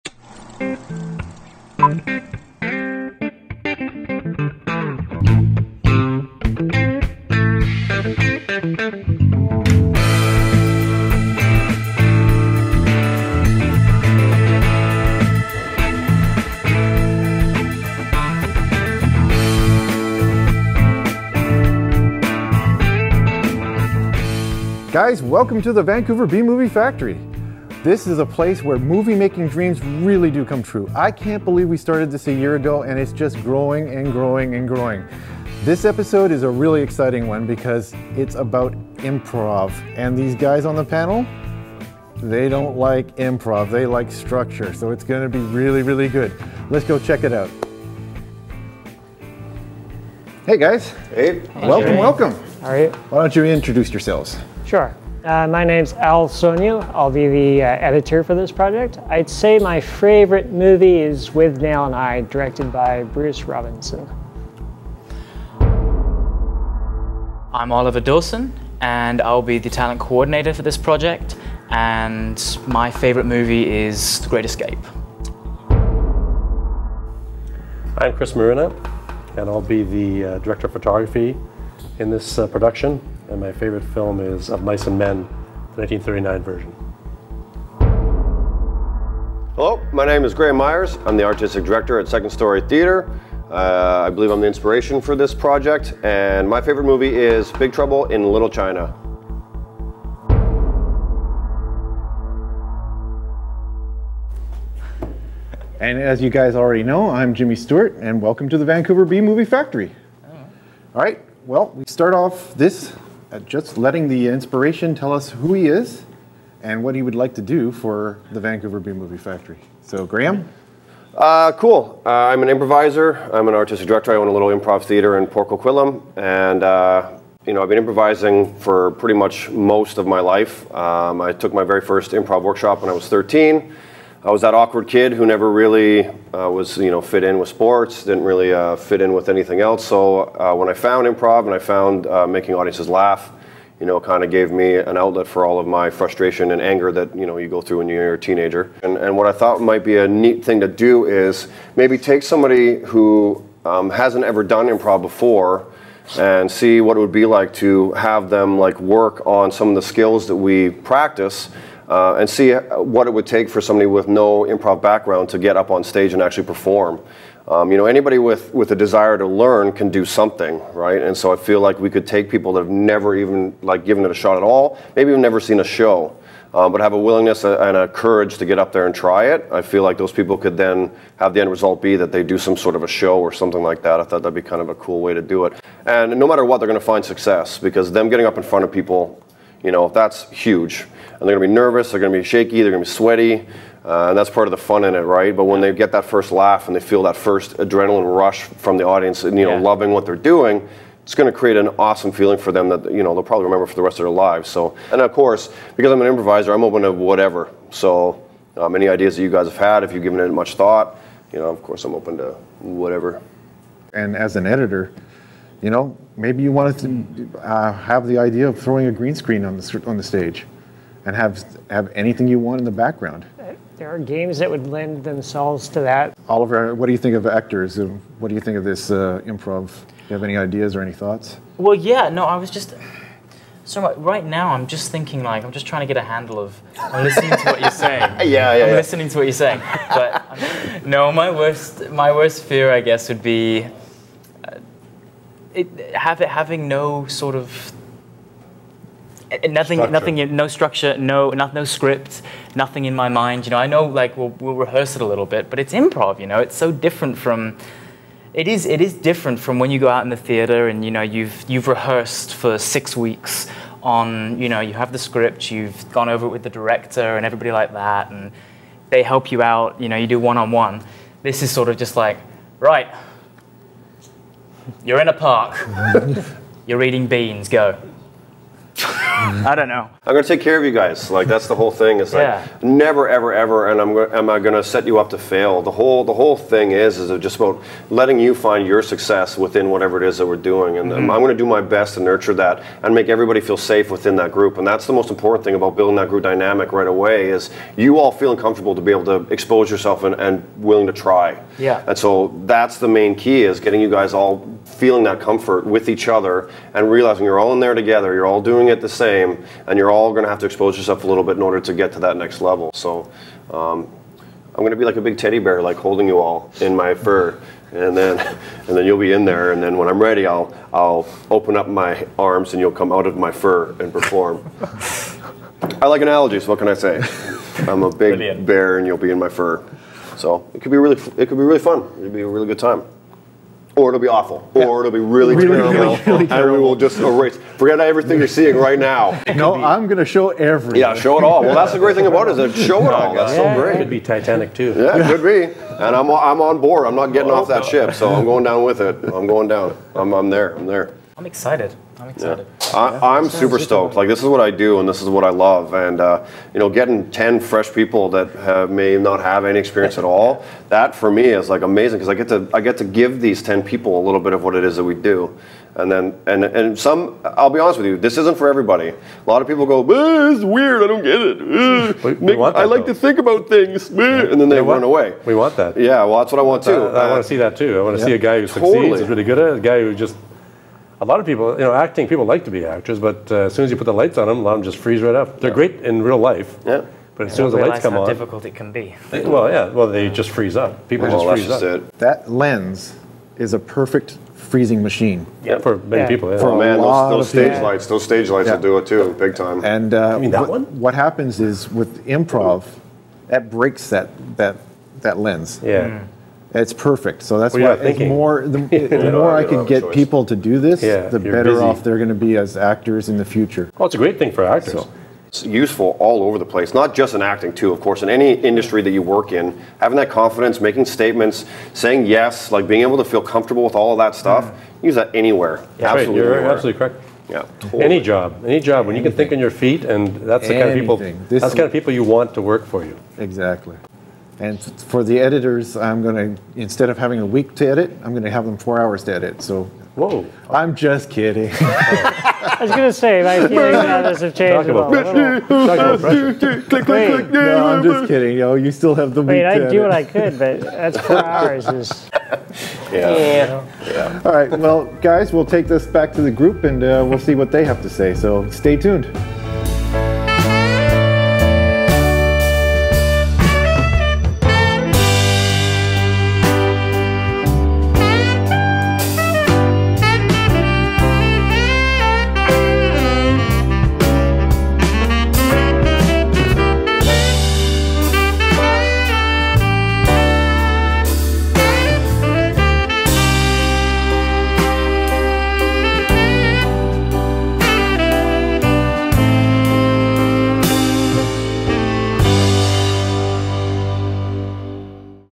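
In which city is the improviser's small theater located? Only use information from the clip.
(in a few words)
Port Coquitlam.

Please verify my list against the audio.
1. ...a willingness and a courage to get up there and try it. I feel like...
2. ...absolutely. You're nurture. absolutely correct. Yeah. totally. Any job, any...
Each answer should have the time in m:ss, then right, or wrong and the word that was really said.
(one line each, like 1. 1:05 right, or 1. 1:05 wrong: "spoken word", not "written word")
1. 2:56 right
2. 7:05 wrong: "anywhere", not "nurture".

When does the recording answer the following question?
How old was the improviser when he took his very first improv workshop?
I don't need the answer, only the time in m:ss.
2:13.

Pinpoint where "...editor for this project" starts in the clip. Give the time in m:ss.
0:57.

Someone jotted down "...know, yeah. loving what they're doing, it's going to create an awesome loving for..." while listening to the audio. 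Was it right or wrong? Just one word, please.
wrong.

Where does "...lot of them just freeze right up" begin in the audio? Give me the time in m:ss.
6:24.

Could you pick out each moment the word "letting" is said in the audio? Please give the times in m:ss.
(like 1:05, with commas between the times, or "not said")
1:53, 4:47.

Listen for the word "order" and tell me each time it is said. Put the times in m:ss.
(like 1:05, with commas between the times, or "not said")
5:11.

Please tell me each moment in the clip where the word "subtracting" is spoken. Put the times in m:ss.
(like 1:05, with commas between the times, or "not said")
not said.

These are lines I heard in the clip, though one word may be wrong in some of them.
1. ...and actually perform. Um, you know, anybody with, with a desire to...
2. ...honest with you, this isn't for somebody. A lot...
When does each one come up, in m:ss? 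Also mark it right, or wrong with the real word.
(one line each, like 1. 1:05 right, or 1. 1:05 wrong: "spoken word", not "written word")
1. 2:46 right
2. 6:07 wrong: "everybody", not "somebody".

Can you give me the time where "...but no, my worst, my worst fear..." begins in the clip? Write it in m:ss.
3:59.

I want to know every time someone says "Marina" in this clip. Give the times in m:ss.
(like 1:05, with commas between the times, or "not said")
1:18.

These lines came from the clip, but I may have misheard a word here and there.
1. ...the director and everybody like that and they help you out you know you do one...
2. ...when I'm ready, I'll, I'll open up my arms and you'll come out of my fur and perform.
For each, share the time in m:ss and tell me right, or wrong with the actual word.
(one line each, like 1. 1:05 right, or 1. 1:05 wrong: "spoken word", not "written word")
1. 4:26 right
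2. 5:19 right.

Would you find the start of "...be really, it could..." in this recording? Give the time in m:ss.
5:30.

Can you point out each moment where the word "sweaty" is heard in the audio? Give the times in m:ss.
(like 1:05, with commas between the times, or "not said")
3:12.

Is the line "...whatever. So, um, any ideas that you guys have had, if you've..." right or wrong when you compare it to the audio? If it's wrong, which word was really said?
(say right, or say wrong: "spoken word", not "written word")
right.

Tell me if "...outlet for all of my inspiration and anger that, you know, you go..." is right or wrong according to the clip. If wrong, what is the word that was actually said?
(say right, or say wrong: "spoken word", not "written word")
wrong: "frustration", not "inspiration".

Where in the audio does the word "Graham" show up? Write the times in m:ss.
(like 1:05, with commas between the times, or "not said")
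1:30, 2:00.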